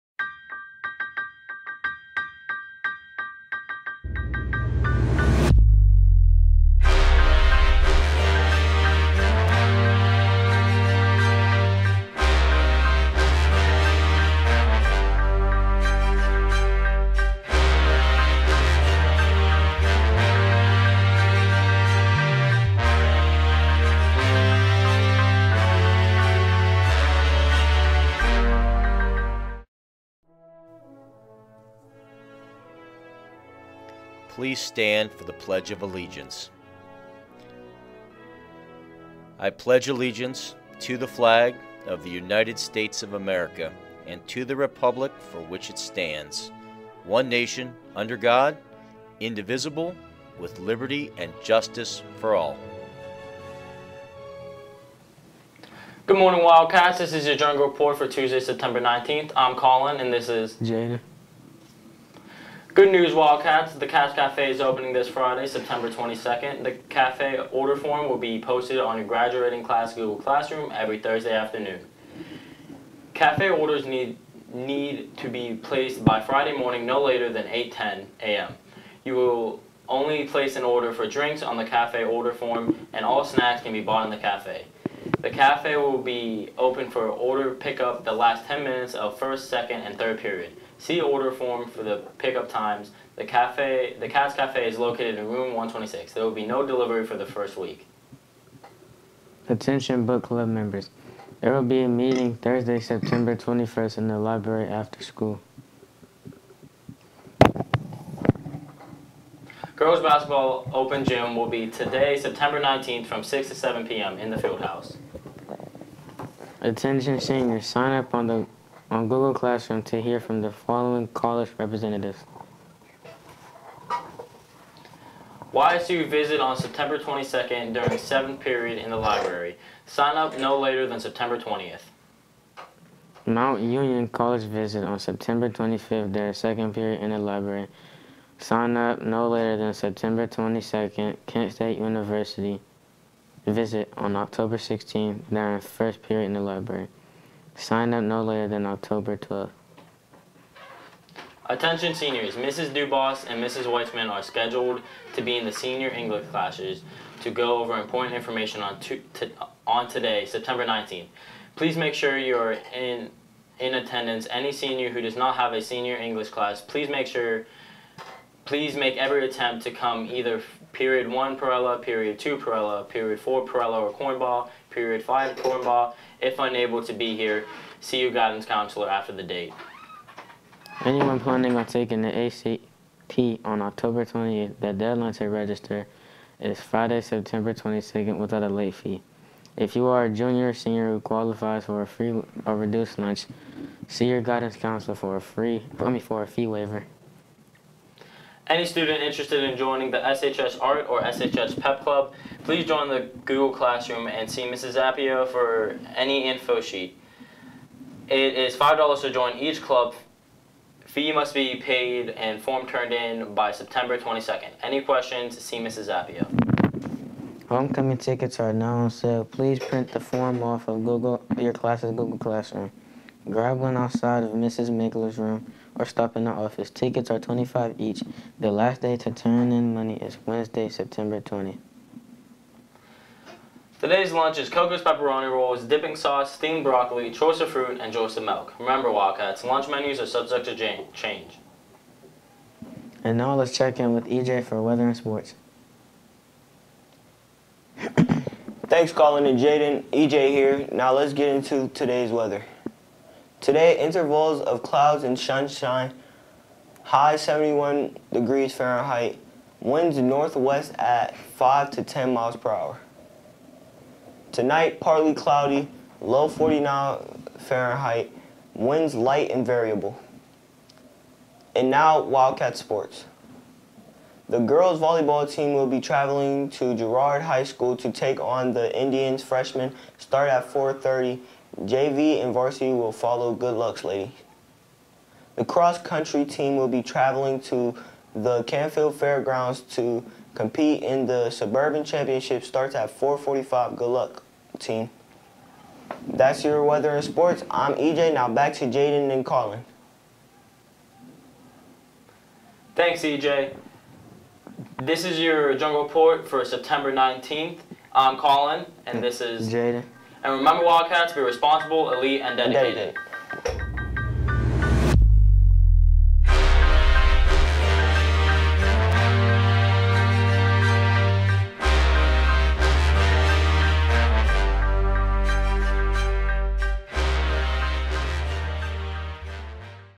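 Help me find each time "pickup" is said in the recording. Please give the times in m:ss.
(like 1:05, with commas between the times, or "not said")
1:27, 1:32.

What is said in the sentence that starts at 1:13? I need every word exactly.
Cafe orders need, need to be placed by Friday morning no later than 8.10 a.m.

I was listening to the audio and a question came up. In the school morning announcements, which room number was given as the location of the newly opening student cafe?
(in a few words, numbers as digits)
126.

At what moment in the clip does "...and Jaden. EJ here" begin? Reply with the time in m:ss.
4:09.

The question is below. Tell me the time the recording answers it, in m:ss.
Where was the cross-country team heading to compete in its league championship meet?
4:48.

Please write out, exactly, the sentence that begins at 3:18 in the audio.
Any student interested in joining the SHS Art or SHS Pep Club, please join the Google Classroom and see Mrs.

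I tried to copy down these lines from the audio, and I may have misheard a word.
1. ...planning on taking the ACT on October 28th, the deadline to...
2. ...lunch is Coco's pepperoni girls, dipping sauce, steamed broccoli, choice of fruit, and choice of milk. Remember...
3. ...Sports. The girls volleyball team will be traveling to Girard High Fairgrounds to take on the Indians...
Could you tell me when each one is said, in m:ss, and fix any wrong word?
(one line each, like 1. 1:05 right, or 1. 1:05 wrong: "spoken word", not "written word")
1. 3:01 right
2. 3:54 wrong: "rolls", not "girls"
3. 4:32 wrong: "School", not "Fairgrounds".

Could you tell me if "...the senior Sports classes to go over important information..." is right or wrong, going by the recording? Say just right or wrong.
wrong.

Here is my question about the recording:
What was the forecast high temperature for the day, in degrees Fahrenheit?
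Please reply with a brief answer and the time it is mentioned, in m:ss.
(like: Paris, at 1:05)
71, at 4:17.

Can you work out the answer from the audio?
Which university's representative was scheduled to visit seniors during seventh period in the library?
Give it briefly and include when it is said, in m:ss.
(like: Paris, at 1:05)
YSU, at 2:05.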